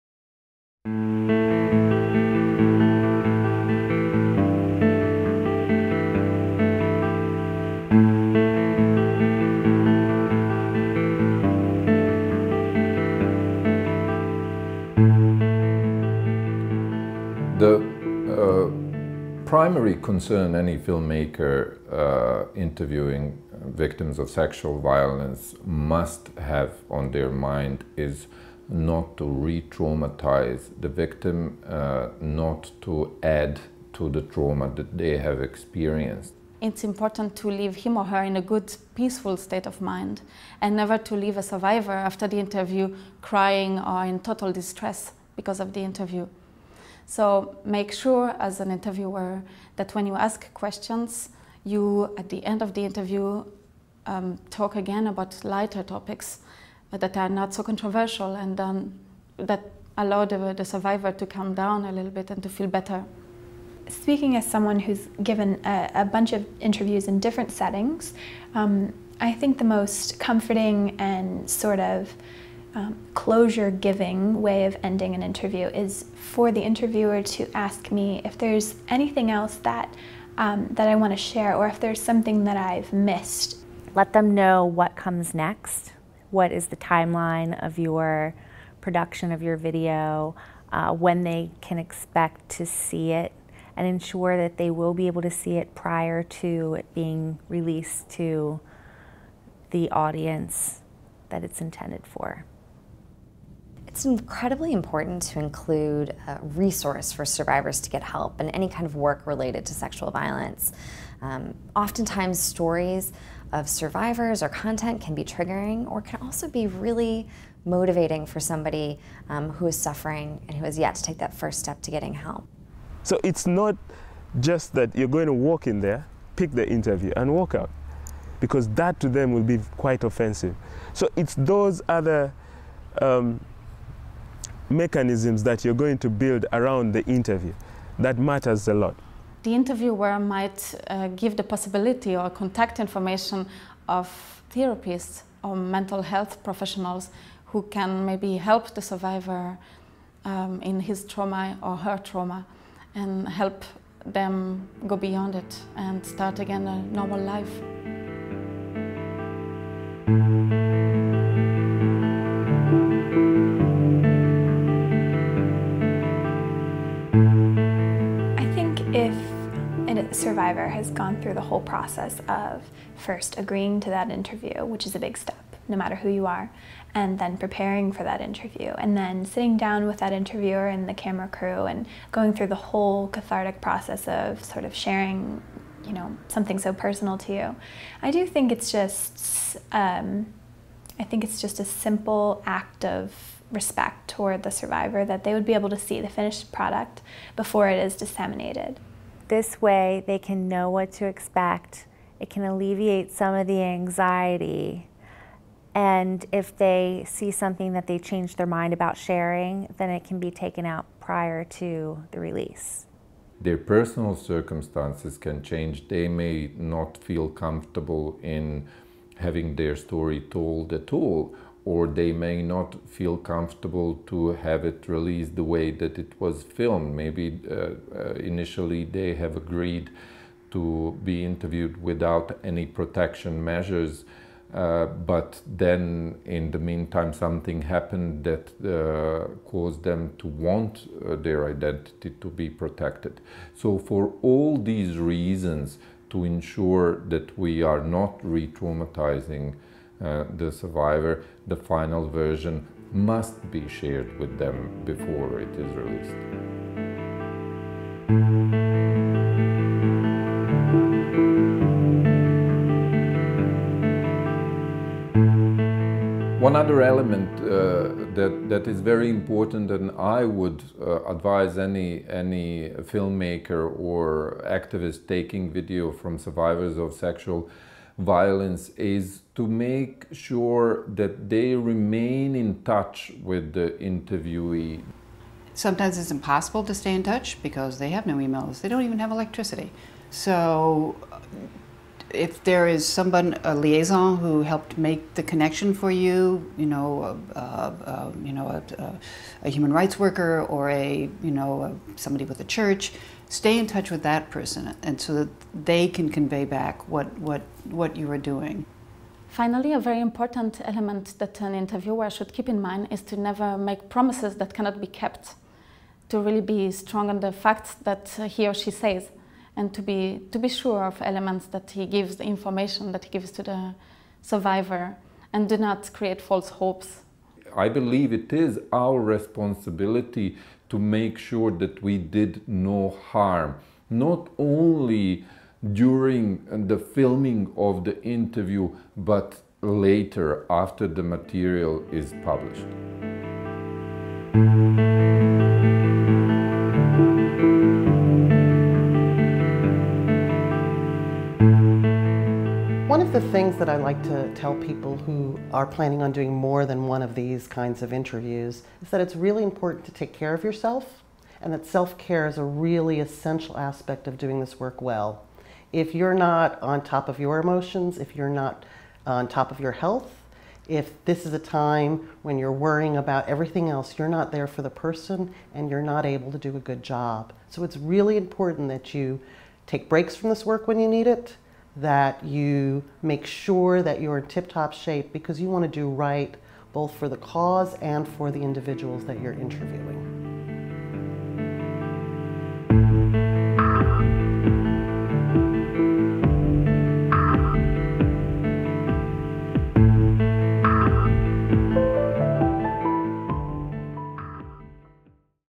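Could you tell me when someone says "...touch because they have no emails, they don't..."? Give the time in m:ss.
4:47.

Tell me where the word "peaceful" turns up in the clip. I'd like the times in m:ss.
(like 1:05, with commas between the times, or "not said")
0:38.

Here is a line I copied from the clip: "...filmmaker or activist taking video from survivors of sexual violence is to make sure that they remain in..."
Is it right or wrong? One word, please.
right.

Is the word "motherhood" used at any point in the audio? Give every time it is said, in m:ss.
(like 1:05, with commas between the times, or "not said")
not said.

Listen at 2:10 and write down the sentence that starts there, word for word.
So it's those other um, mechanisms that you're going to build around the interview.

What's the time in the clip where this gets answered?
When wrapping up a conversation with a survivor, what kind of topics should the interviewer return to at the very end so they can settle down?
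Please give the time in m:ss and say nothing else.
0:55.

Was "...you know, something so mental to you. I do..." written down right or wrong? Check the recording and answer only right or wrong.
wrong.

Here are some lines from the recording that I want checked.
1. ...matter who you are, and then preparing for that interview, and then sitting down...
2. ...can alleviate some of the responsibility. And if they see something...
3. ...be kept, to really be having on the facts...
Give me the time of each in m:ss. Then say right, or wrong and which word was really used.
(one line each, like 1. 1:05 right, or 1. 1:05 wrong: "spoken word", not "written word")
1. 2:55 right
2. 3:22 wrong: "anxiety", not "responsibility"
3. 5:14 wrong: "strong", not "having".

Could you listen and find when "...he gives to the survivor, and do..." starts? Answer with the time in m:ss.
5:23.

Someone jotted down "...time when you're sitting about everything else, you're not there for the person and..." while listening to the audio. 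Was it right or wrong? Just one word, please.
wrong.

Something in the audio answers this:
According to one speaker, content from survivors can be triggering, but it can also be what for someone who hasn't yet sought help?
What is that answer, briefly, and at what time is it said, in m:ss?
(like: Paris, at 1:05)
really motivating, at 1:56.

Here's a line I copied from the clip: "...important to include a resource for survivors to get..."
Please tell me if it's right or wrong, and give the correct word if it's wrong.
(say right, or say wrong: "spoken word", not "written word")
right.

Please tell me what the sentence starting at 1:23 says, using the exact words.
Let them know what comes next.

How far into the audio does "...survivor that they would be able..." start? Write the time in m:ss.
3:14.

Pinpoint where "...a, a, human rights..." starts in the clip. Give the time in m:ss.
4:58.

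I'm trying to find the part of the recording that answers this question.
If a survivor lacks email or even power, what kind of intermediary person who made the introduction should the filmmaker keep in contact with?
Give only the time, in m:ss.
4:53.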